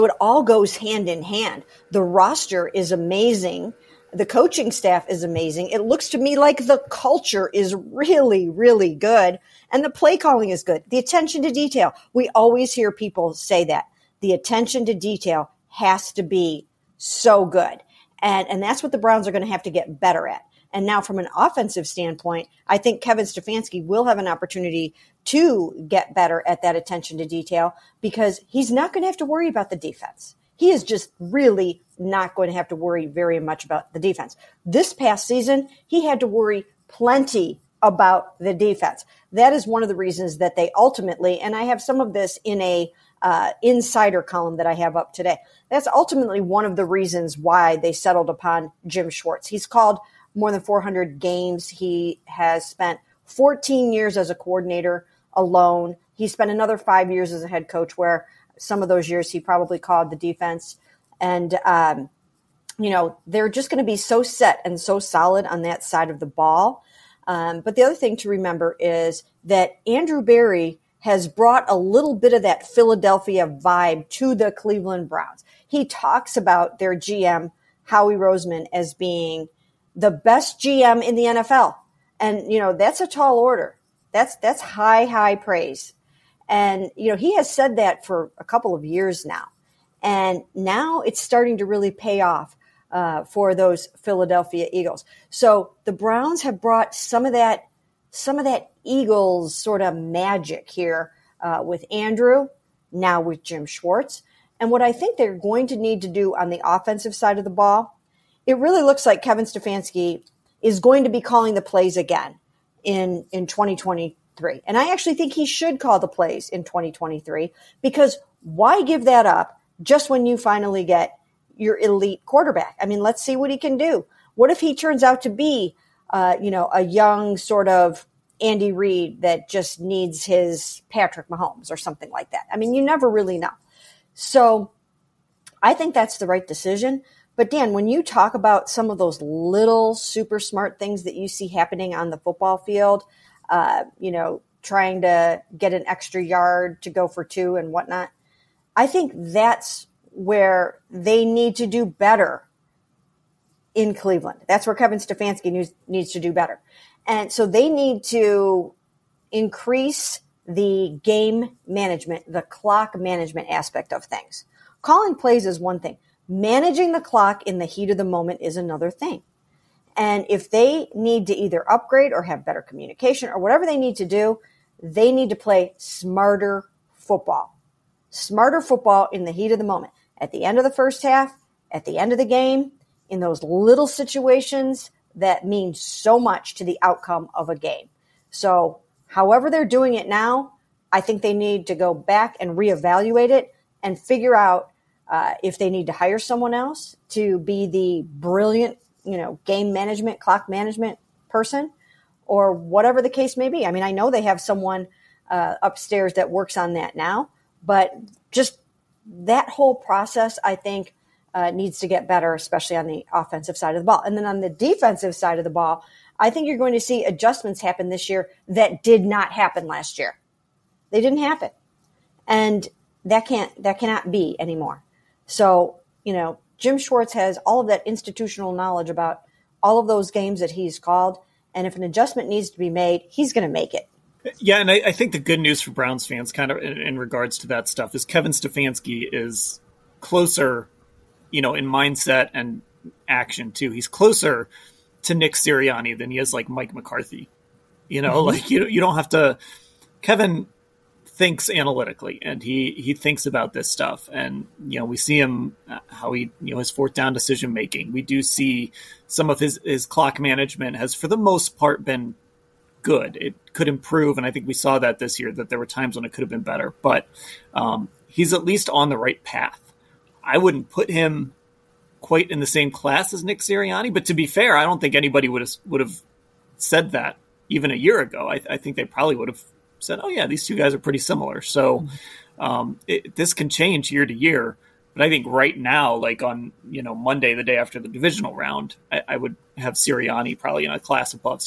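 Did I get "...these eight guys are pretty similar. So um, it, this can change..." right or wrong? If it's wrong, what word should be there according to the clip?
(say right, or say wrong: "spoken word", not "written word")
wrong: "two", not "eight".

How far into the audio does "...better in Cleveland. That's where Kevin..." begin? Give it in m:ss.
2:31.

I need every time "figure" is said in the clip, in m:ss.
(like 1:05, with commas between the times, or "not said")
3:13.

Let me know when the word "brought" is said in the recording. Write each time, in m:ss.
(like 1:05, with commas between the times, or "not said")
1:11, 1:36.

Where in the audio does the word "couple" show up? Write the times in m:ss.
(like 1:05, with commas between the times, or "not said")
1:28.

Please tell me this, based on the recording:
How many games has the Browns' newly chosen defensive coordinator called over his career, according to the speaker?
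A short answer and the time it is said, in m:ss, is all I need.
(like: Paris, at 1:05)
more than 400, at 0:50.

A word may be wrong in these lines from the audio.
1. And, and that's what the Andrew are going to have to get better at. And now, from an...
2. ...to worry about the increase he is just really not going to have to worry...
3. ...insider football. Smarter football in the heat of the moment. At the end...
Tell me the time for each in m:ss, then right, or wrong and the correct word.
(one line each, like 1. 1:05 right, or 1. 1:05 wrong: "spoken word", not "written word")
1. 0:18 wrong: "Browns", not "Andrew"
2. 0:29 wrong: "defense", not "increase"
3. 2:55 wrong: "smarter", not "insider".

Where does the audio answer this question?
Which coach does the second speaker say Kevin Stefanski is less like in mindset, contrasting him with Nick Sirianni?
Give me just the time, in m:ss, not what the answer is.
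4:06.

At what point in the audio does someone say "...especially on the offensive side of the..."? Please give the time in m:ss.
3:32.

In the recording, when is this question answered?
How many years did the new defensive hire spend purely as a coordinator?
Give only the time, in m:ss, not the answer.
0:53.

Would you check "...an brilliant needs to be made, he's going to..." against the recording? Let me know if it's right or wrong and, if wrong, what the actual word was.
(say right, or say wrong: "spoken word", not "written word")
wrong: "adjustment", not "brilliant".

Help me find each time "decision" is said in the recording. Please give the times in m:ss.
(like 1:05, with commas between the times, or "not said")
2:16, 4:17.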